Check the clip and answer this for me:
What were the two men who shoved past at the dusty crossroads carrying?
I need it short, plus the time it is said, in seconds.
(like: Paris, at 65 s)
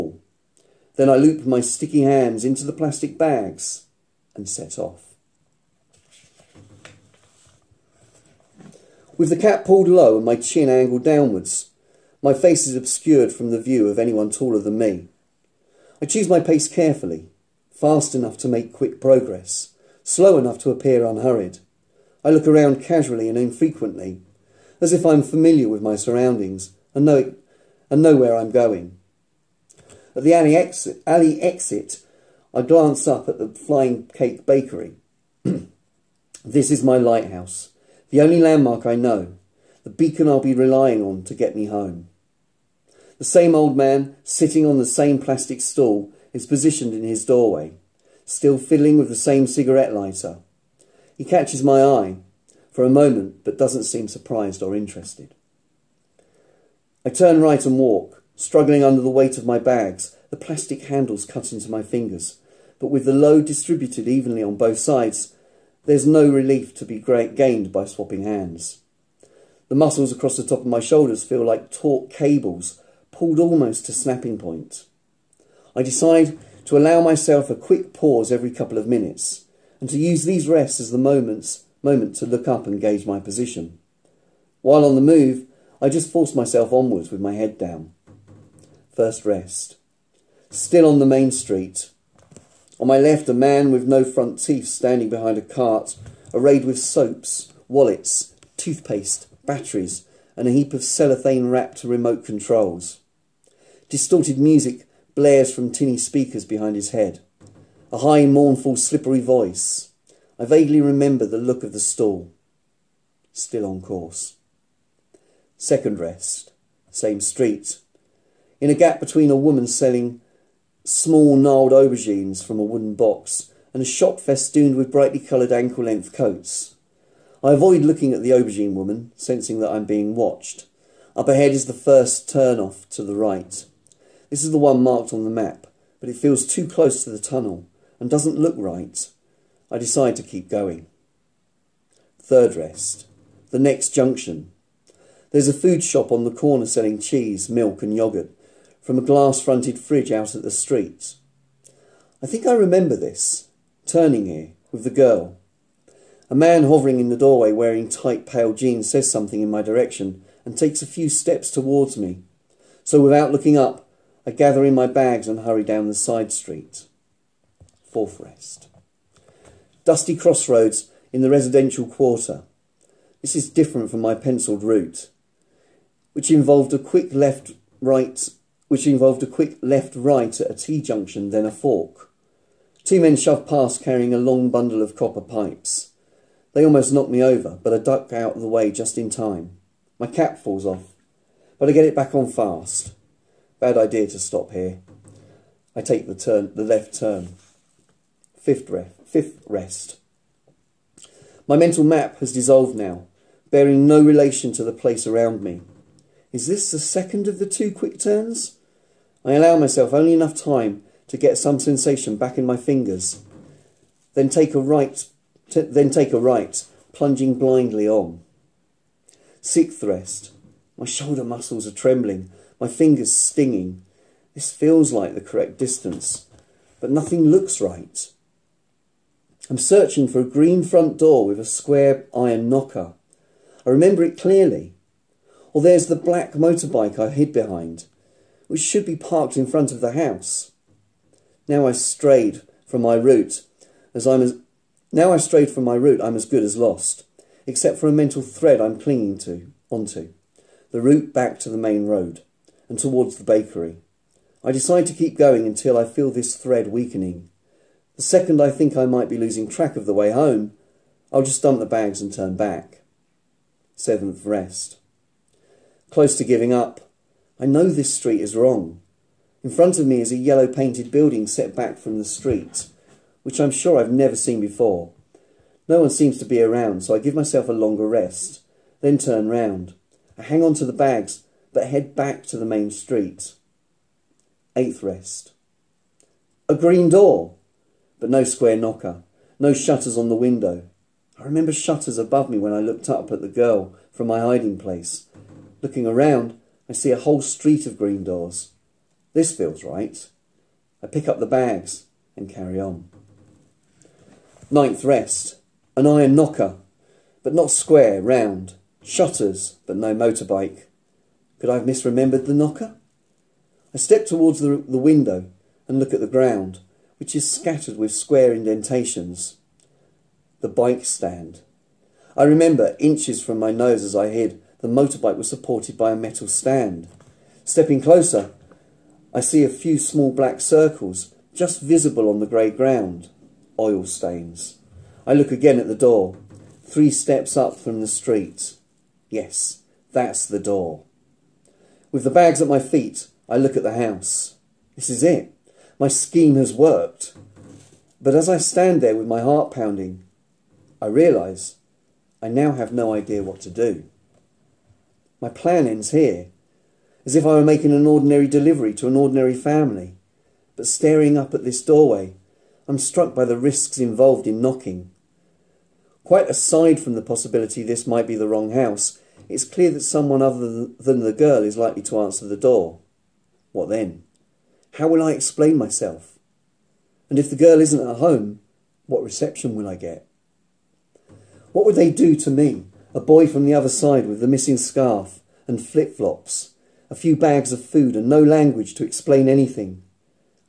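copper pipes, at 184 s.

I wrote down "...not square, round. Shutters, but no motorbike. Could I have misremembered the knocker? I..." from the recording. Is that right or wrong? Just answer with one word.
right.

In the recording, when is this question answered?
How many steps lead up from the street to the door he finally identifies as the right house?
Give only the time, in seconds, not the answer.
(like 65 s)
336 s.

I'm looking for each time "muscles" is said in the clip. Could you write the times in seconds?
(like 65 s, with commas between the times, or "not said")
69 s, 221 s.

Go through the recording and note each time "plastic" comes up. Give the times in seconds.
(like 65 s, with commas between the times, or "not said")
2 s, 45 s, 60 s.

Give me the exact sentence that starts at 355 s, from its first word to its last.
My plan ends here, as if I were making an ordinary delivery to an ordinary family.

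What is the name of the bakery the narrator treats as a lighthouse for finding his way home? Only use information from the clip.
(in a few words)
Flying Cake Bakery.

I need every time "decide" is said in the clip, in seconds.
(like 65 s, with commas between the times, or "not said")
75 s, 139 s, 254 s.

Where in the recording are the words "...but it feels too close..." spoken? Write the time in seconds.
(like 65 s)
136 s.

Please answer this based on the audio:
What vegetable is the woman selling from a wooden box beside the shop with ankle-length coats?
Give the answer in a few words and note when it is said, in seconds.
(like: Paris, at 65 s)
aubergines, at 121 s.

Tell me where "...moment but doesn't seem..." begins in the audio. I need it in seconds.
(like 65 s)
52 s.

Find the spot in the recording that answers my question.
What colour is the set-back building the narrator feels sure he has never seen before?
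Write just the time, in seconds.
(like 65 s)
270 s.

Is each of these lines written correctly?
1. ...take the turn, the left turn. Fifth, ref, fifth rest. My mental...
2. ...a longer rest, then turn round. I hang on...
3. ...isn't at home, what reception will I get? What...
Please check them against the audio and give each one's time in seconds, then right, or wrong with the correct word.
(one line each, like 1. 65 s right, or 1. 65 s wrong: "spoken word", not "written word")
1. 195 s right
2. 277 s right
3. 377 s right.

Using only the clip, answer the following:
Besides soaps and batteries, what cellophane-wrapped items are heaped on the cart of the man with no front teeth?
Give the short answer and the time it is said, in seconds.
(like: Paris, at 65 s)
remote controls, at 101 s.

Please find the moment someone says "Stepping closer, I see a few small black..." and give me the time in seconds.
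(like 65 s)
327 s.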